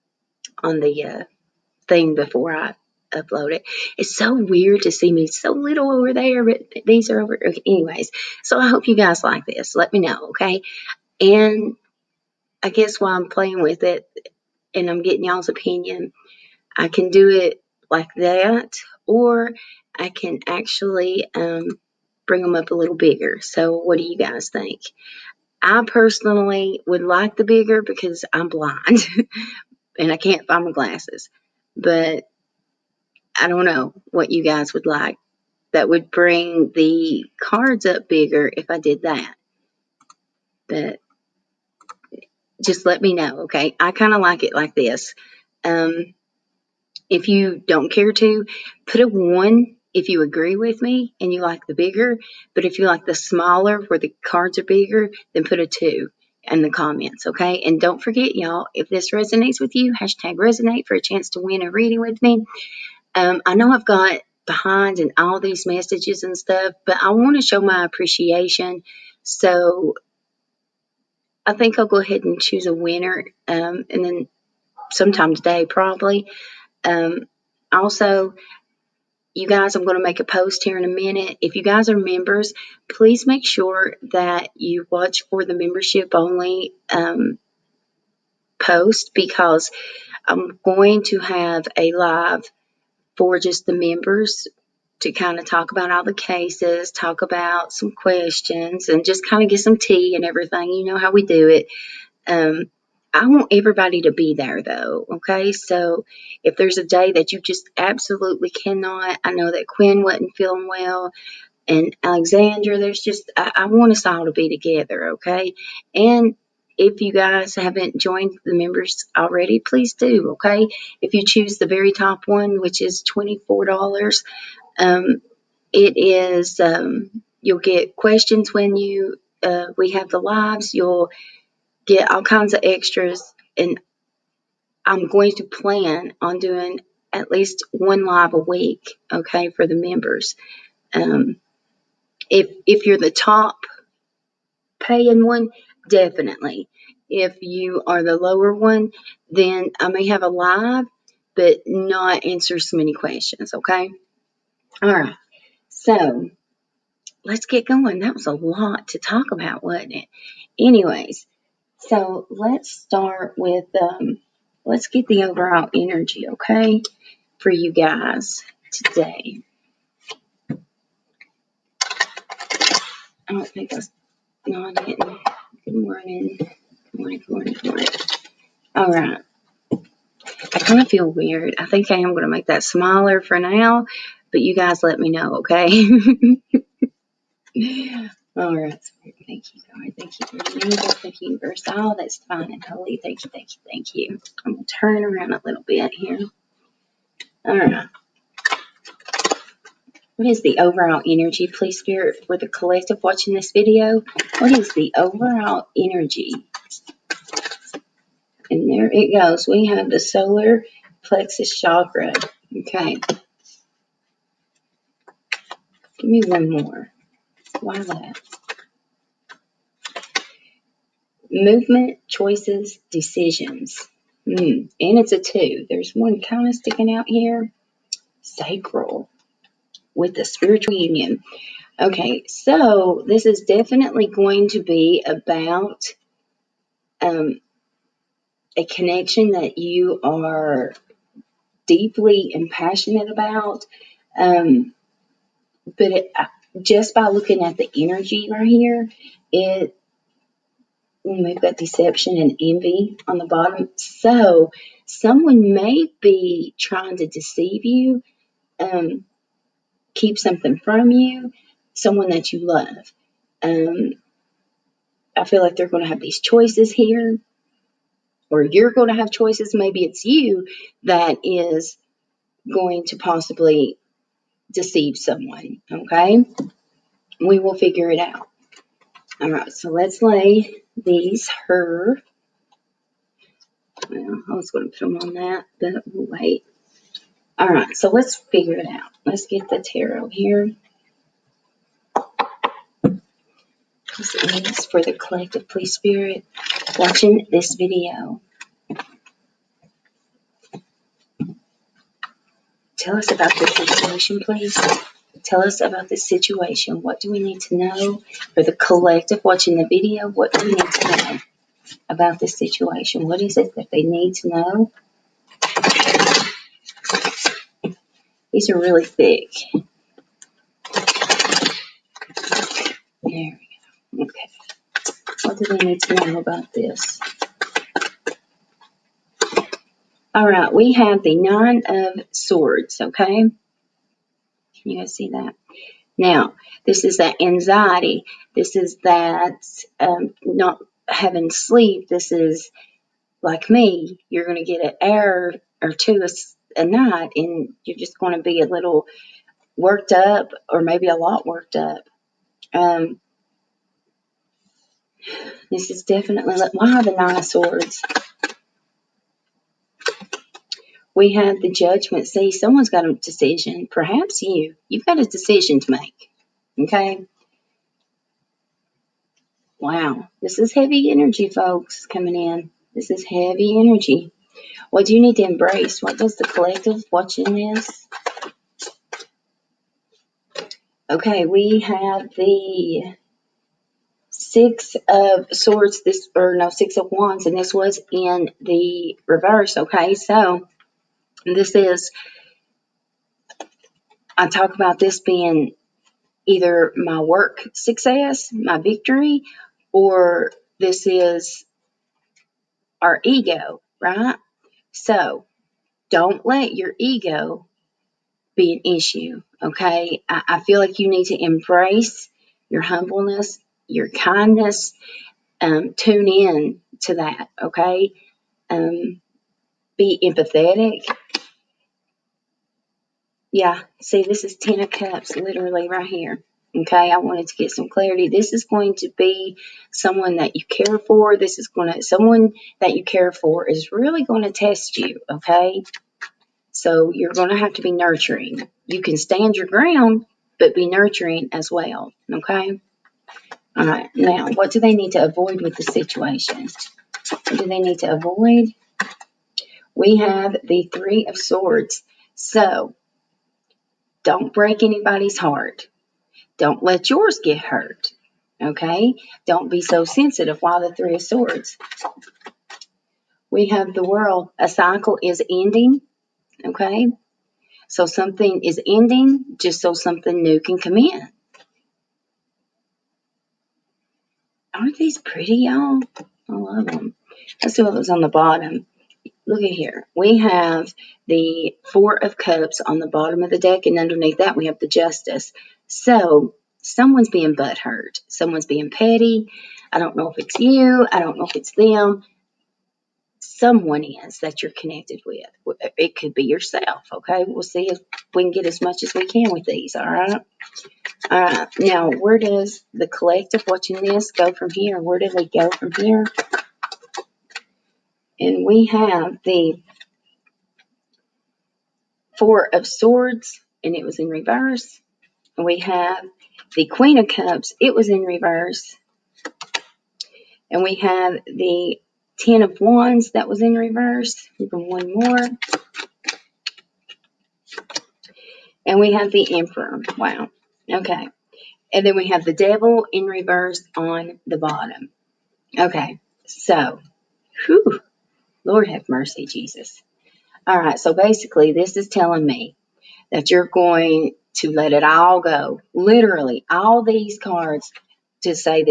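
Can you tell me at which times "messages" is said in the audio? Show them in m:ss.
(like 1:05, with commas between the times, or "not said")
1:05.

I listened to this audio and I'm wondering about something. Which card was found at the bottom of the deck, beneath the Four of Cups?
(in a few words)
Justice.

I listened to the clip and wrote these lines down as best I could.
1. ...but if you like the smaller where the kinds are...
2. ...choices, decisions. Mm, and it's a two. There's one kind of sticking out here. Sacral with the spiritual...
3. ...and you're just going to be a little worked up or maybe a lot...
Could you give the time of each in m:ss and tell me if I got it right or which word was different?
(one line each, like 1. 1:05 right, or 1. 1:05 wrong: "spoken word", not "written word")
1. 0:52 wrong: "cards", not "kinds"
2. 3:42 right
3. 5:47 right.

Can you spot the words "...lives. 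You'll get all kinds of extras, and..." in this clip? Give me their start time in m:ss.
2:10.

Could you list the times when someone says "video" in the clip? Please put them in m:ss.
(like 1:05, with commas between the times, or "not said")
3:23, 4:57, 5:09.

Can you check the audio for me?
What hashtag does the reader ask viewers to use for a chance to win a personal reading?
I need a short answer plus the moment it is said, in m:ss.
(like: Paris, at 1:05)
resonate, at 0:59.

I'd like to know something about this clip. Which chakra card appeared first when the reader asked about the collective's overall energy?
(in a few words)
solar plexus.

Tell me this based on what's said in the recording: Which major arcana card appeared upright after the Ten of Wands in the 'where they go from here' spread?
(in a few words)
the Emperor.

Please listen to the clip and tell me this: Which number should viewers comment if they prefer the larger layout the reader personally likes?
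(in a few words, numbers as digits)
1.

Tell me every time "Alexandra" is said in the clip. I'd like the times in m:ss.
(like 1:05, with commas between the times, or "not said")
1:52.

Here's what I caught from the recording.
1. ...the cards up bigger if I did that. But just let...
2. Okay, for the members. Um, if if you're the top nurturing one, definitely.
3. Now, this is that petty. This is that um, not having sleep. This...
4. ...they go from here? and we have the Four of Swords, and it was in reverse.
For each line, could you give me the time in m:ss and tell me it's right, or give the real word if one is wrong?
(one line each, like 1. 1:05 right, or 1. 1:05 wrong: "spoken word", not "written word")
1. 0:36 right
2. 2:19 wrong: "paying", not "nurturing"
3. 5:35 wrong: "anxiety", not "petty"
4. 8:25 right.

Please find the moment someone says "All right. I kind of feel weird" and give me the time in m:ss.
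2:58.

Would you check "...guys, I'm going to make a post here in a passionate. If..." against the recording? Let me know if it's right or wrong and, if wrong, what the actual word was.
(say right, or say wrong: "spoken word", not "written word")
wrong: "minute", not "passionate".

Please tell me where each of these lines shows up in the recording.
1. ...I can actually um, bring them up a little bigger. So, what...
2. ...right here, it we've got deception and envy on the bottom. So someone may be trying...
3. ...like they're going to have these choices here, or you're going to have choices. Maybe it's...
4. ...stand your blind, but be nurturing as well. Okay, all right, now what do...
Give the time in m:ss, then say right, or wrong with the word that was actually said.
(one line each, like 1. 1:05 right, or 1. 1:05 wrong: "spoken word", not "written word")
1. 0:19 right
2. 4:08 right
3. 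4:25 right
4. 7:18 wrong: "ground", not "blind".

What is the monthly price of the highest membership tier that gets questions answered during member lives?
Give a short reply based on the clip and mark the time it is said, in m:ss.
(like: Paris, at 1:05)
$24, at 2:03.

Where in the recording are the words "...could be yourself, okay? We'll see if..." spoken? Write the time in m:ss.
8:15.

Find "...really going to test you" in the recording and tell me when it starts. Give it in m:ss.
7:13.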